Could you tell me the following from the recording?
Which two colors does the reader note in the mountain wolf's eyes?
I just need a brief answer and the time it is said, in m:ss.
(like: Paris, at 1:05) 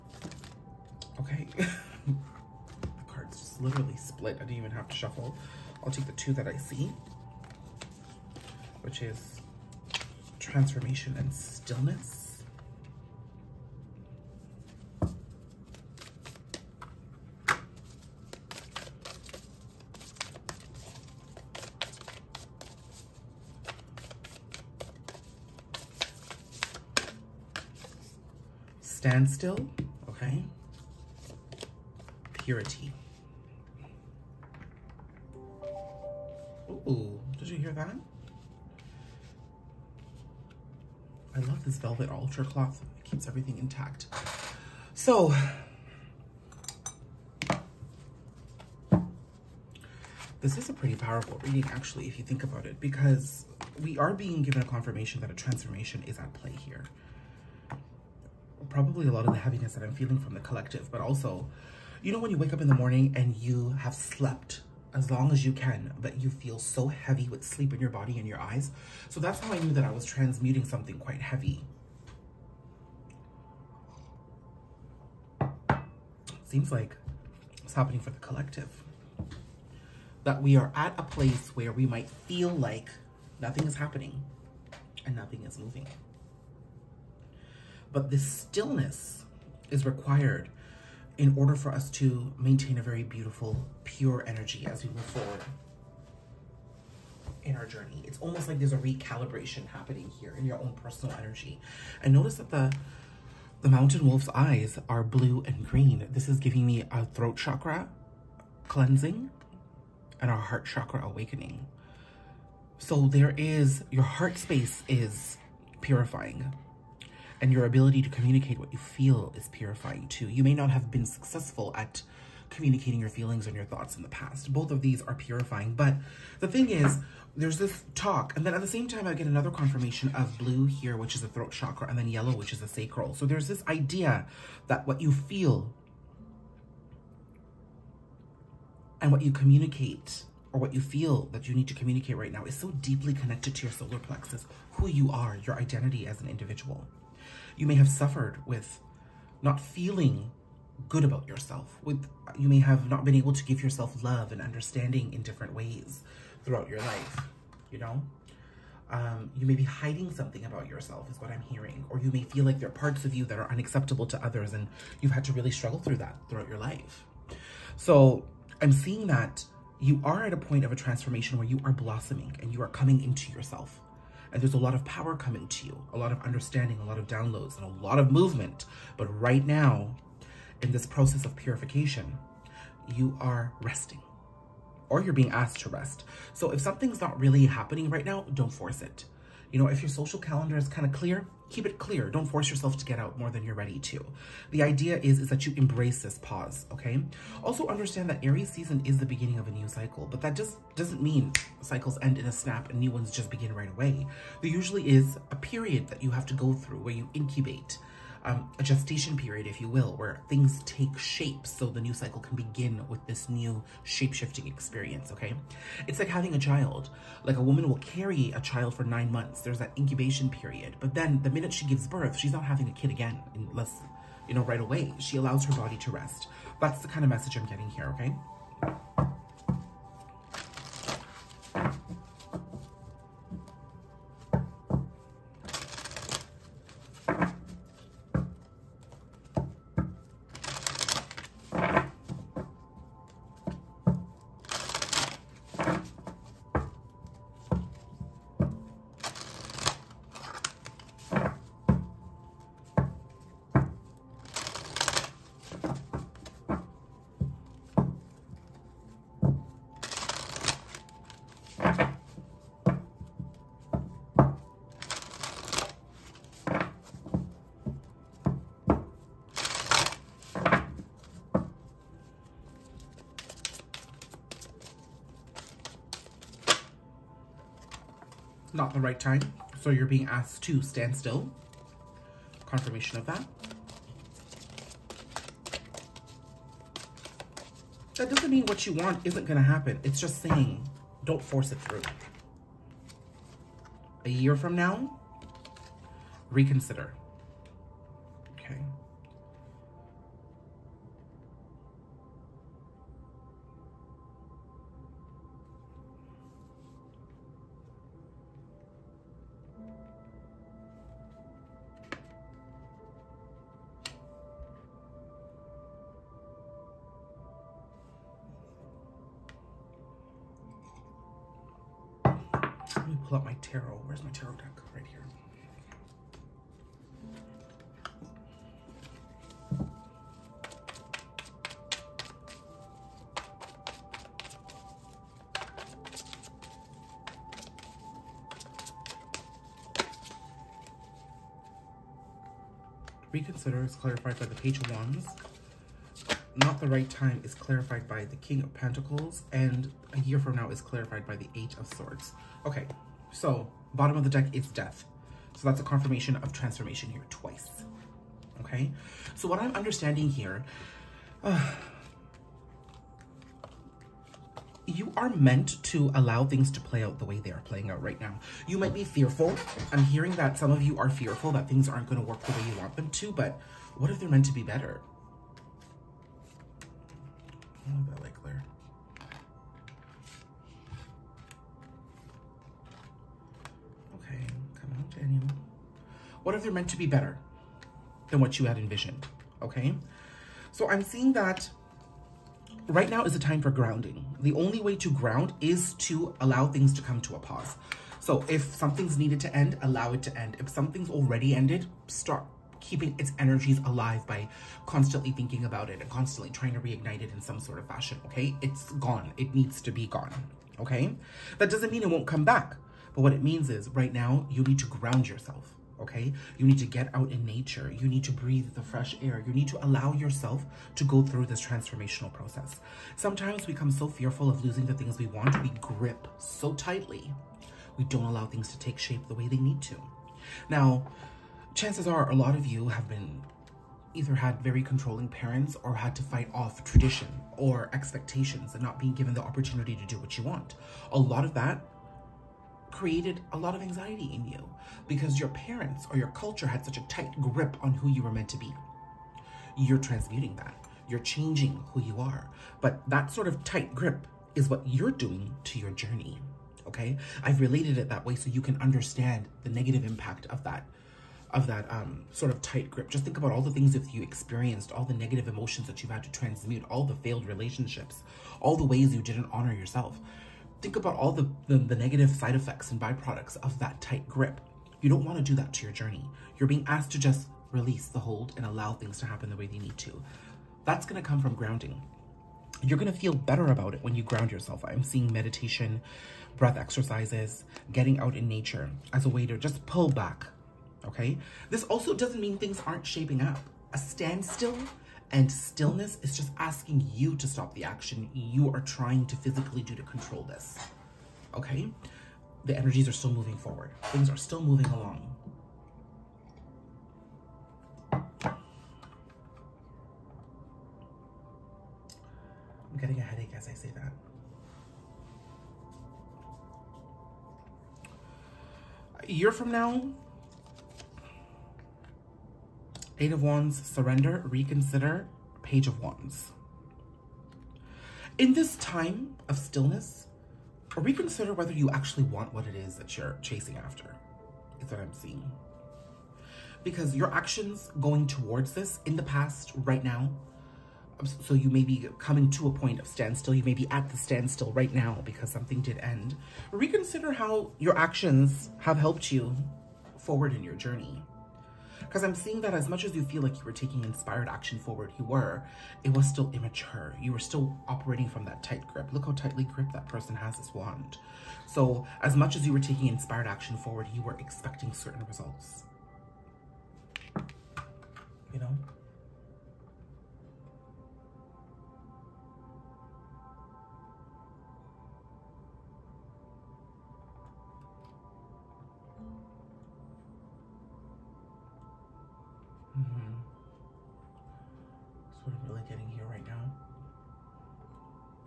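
blue and green, at 1:45.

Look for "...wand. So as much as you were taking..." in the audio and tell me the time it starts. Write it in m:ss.
9:20.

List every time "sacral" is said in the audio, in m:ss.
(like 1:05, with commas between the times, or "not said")
2:12.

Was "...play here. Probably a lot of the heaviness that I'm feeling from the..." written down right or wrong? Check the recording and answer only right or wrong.
right.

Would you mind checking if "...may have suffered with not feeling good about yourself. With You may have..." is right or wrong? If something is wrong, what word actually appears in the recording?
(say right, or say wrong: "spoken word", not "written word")
right.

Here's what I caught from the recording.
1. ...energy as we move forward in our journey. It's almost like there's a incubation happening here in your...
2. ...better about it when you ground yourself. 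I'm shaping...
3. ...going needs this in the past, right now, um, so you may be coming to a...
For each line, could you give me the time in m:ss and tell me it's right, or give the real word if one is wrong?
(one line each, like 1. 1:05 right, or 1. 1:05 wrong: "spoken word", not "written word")
1. 1:34 wrong: "recalibration", not "incubation"
2. 8:03 wrong: "seeing", not "shaping"
3. 8:57 wrong: "towards", not "needs".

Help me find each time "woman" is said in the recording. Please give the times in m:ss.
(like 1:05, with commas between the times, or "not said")
3:37.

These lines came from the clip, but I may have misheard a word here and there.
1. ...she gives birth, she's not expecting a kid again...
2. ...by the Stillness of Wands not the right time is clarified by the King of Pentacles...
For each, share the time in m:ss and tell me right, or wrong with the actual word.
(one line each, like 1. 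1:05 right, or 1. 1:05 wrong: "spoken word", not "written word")
1. 3:41 wrong: "having", not "expecting"
2. 5:44 wrong: "Page", not "Stillness".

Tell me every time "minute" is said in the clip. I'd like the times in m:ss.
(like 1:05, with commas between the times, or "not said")
3:41.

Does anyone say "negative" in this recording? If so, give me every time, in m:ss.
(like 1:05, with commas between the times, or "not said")
7:39, 7:44, 7:51.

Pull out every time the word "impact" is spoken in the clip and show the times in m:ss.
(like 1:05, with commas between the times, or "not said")
7:39.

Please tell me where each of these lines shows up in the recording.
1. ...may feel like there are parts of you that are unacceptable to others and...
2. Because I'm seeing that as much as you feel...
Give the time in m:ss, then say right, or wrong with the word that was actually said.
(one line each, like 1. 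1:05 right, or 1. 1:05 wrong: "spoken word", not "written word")
1. 2:42 right
2. 9:11 right.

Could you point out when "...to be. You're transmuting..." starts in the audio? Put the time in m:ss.
7:28.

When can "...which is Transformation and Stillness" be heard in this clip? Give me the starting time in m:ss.
0:08.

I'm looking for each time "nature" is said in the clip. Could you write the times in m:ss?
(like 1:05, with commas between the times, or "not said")
6:57, 8:08.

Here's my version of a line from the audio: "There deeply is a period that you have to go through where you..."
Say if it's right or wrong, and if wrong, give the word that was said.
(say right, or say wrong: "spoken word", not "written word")
wrong: "usually", not "deeply".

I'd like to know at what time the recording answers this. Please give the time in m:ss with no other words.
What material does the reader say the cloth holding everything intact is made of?
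0:41.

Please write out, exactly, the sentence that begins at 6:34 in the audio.
The only way to ground is to allow things to come to a pause.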